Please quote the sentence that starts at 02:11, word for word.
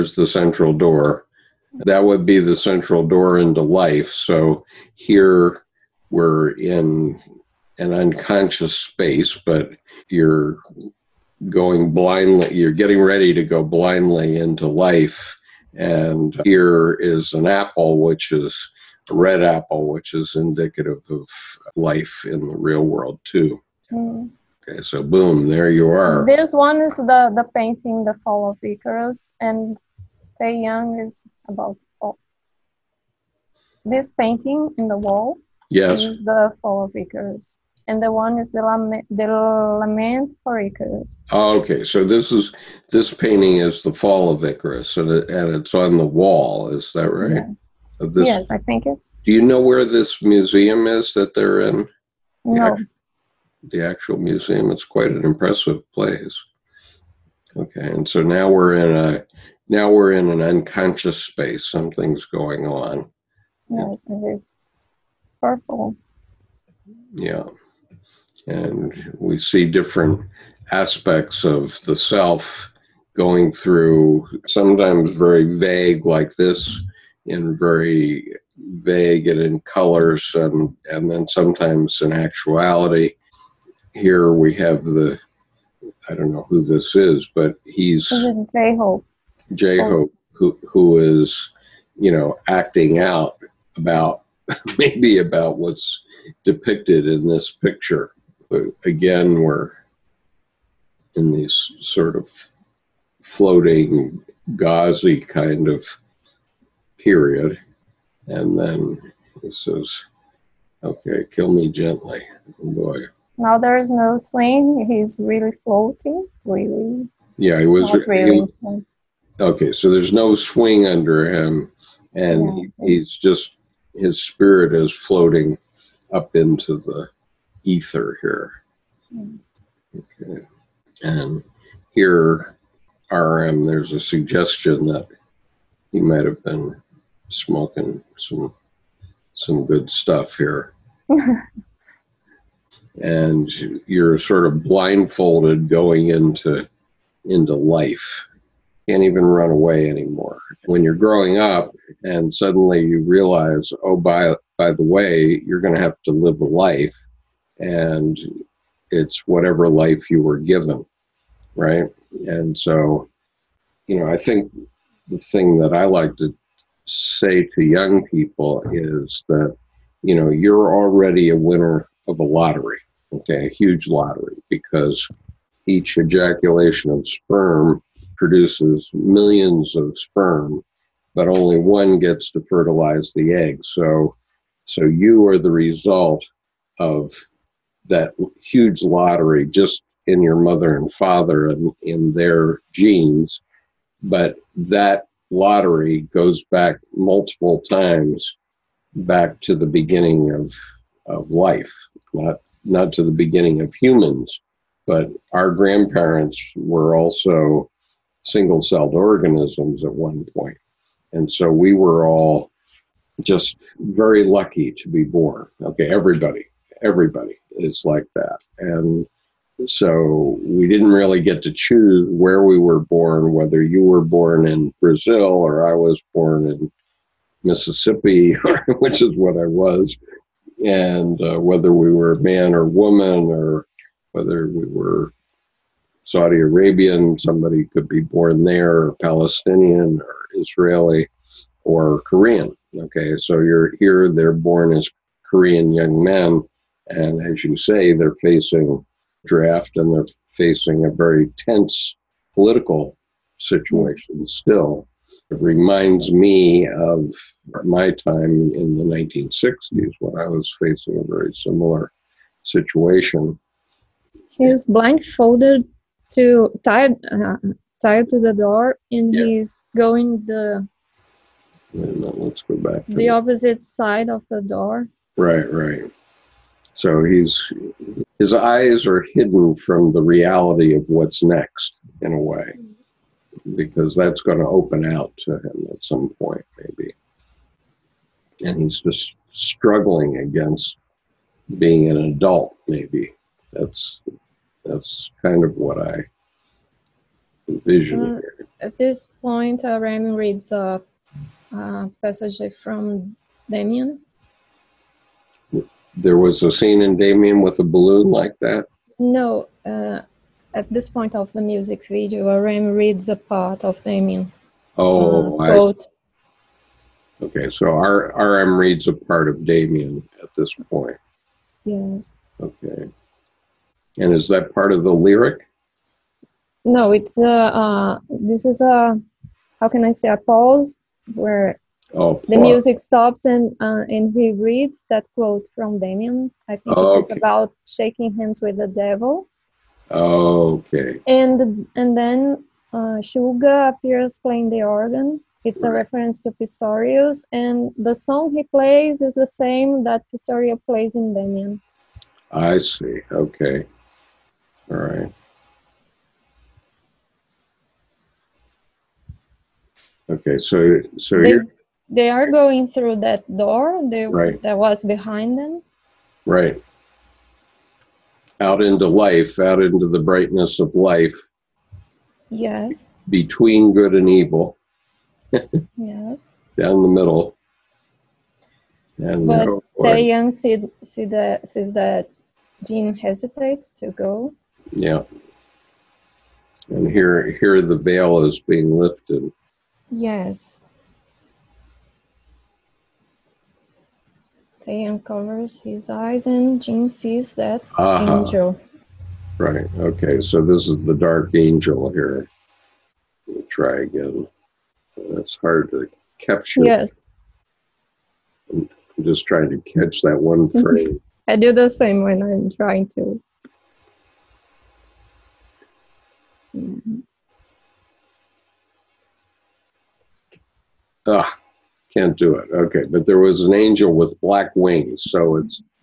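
And here, RM, there's a suggestion that he might have been smoking some some good stuff here.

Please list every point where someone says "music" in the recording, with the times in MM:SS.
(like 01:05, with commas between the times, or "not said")
05:11, 05:32.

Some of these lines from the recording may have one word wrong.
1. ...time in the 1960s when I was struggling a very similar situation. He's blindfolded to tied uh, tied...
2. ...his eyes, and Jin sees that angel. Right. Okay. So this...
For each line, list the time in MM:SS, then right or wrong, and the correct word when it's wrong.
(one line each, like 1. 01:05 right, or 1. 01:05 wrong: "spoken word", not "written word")
1. 04:17 wrong: "facing", not "struggling"
2. 06:35 right.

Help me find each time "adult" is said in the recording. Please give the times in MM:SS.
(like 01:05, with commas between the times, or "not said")
04:52.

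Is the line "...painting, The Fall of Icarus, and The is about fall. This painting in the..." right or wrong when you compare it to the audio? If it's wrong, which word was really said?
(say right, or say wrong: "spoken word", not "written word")
wrong: "Taehyung", not "The".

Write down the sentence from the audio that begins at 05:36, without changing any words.
it's about shaking hands with the devil.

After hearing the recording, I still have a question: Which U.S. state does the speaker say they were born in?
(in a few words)
Mississippi.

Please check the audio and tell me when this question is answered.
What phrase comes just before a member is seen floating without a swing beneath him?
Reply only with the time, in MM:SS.
01:51.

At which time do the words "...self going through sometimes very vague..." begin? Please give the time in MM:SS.
01:11.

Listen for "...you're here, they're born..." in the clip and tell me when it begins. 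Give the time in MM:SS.
04:03.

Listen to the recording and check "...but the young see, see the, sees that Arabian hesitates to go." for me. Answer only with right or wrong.
wrong.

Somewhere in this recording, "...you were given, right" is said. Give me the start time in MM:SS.
02:40.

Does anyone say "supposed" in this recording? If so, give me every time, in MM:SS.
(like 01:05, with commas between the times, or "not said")
not said.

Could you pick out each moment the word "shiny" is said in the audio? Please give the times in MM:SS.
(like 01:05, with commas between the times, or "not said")
not said.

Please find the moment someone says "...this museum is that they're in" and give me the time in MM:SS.
00:49.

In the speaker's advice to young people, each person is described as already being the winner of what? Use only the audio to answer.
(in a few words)
A lottery.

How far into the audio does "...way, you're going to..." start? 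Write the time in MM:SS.
02:34.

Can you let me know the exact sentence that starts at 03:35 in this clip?
Okay, everybody, everybody is like that.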